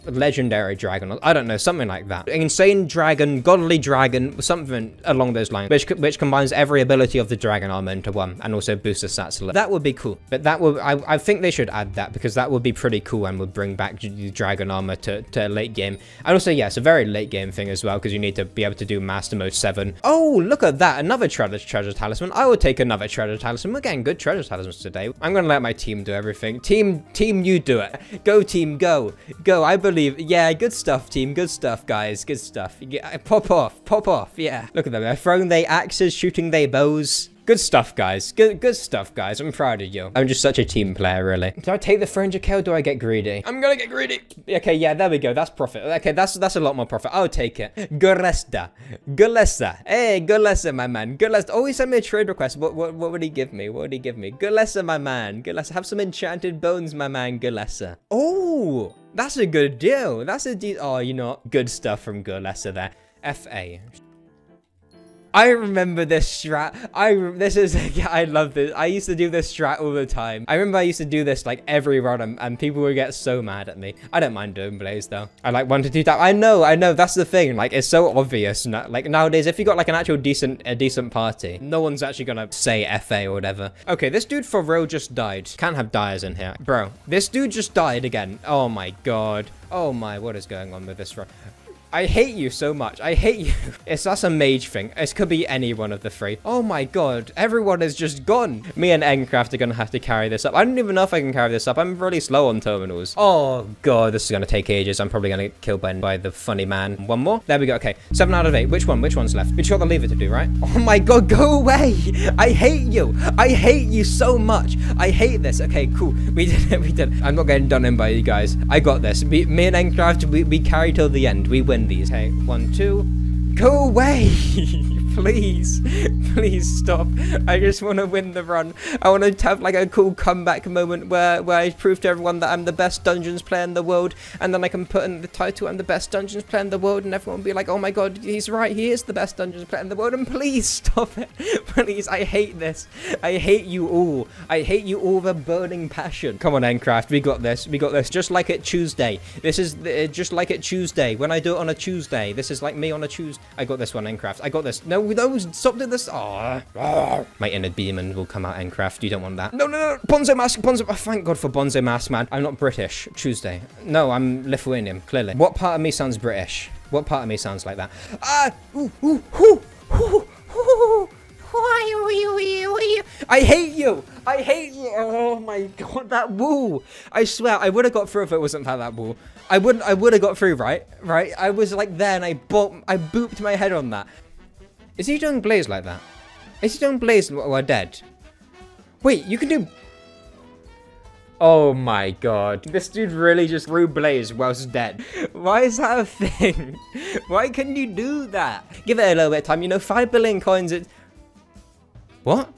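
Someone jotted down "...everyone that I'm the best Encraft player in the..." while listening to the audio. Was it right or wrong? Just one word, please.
wrong.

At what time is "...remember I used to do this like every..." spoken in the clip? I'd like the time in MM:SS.
01:10.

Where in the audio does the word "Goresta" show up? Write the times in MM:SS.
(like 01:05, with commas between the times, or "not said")
00:47.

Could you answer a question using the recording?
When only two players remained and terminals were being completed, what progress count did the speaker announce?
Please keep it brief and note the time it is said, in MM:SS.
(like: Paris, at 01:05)
7 out of 8, at 01:48.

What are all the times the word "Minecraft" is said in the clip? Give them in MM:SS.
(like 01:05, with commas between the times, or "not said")
02:34, 02:38.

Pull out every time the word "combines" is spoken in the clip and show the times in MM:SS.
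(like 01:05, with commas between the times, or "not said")
00:06.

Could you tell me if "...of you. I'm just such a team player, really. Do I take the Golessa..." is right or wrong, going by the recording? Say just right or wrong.
wrong.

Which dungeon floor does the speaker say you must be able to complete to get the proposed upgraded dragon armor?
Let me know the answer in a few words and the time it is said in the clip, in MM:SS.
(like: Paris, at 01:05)
Master mode 7, at 00:19.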